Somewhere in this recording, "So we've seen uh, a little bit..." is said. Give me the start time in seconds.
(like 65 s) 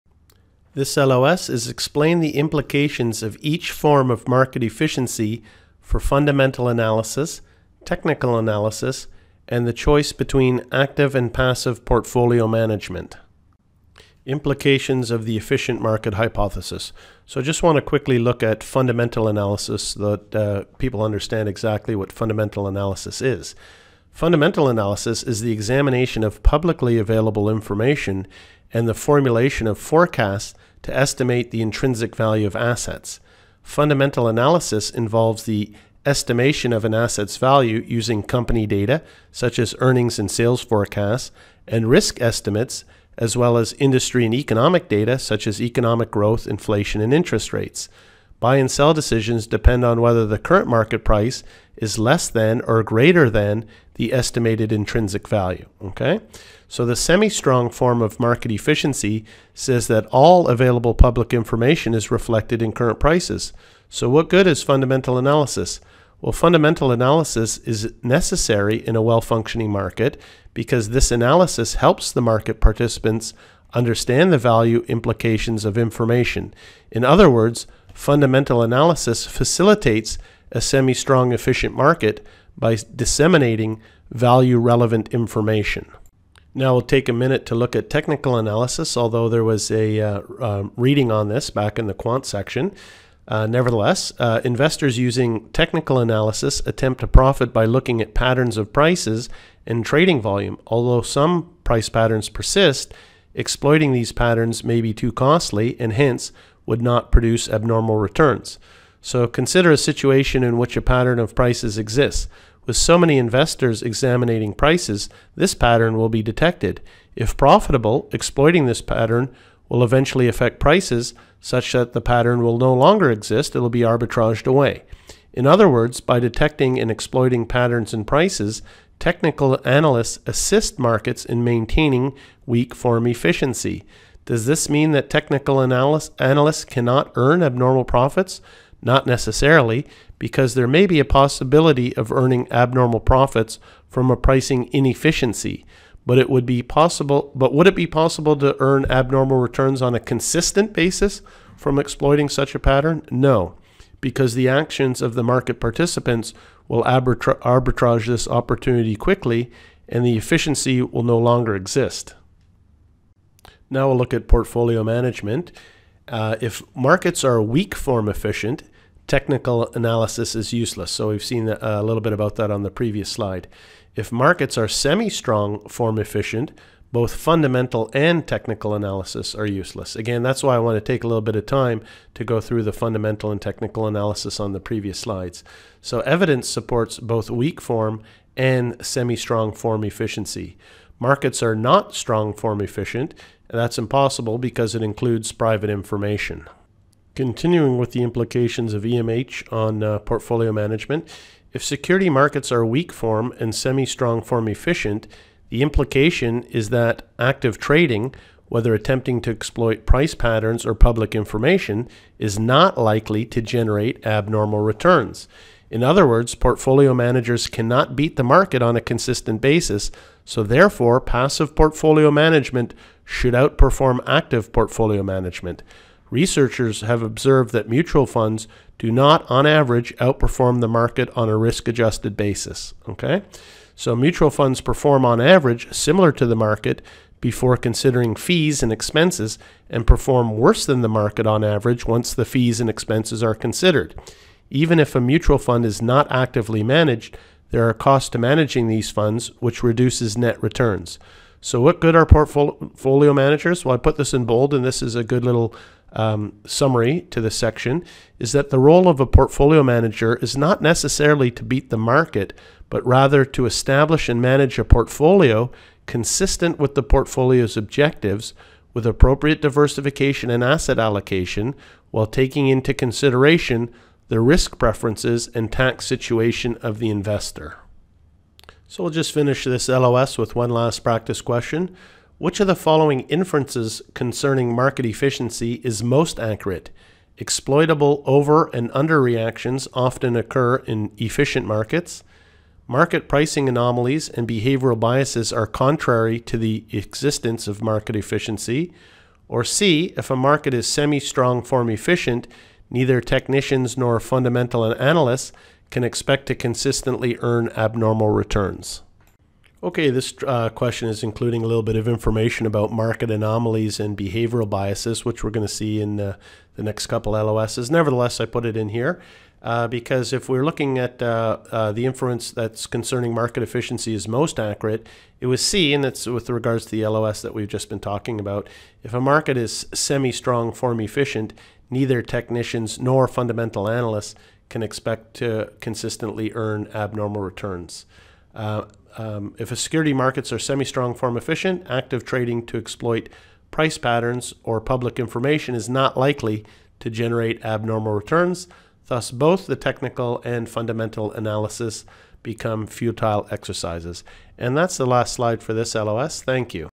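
170 s.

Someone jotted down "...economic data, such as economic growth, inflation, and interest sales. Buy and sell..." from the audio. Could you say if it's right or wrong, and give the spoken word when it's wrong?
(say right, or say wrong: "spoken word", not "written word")
wrong: "rates", not "sales".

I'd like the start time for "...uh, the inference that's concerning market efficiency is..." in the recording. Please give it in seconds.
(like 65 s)
321 s.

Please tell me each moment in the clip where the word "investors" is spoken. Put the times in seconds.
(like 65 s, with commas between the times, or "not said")
94 s, 113 s, 276 s.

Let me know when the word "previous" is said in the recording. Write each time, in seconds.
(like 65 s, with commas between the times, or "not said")
172 s, 184 s.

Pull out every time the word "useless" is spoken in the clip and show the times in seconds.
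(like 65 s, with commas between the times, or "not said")
170 s, 179 s.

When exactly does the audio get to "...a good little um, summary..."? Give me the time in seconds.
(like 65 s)
254 s.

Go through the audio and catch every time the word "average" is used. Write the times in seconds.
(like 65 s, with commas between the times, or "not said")
229 s, 235 s, 241 s.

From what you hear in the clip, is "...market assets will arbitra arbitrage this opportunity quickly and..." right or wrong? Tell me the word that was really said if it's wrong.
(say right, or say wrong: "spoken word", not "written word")
wrong: "participants", not "assets".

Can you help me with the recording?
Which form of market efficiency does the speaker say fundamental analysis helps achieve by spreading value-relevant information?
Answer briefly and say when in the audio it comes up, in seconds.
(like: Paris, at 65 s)
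semi-strong efficient, at 80 s.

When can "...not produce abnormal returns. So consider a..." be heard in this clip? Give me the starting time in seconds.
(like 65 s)
106 s.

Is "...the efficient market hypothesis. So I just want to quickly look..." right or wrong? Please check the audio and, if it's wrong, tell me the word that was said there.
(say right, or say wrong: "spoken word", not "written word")
right.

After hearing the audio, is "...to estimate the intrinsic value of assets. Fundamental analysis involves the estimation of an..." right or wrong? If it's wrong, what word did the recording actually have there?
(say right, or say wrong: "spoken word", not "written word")
right.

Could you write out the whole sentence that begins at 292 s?
Market pricing anomalies and behavioral biases are contrary to the existence of market efficiency.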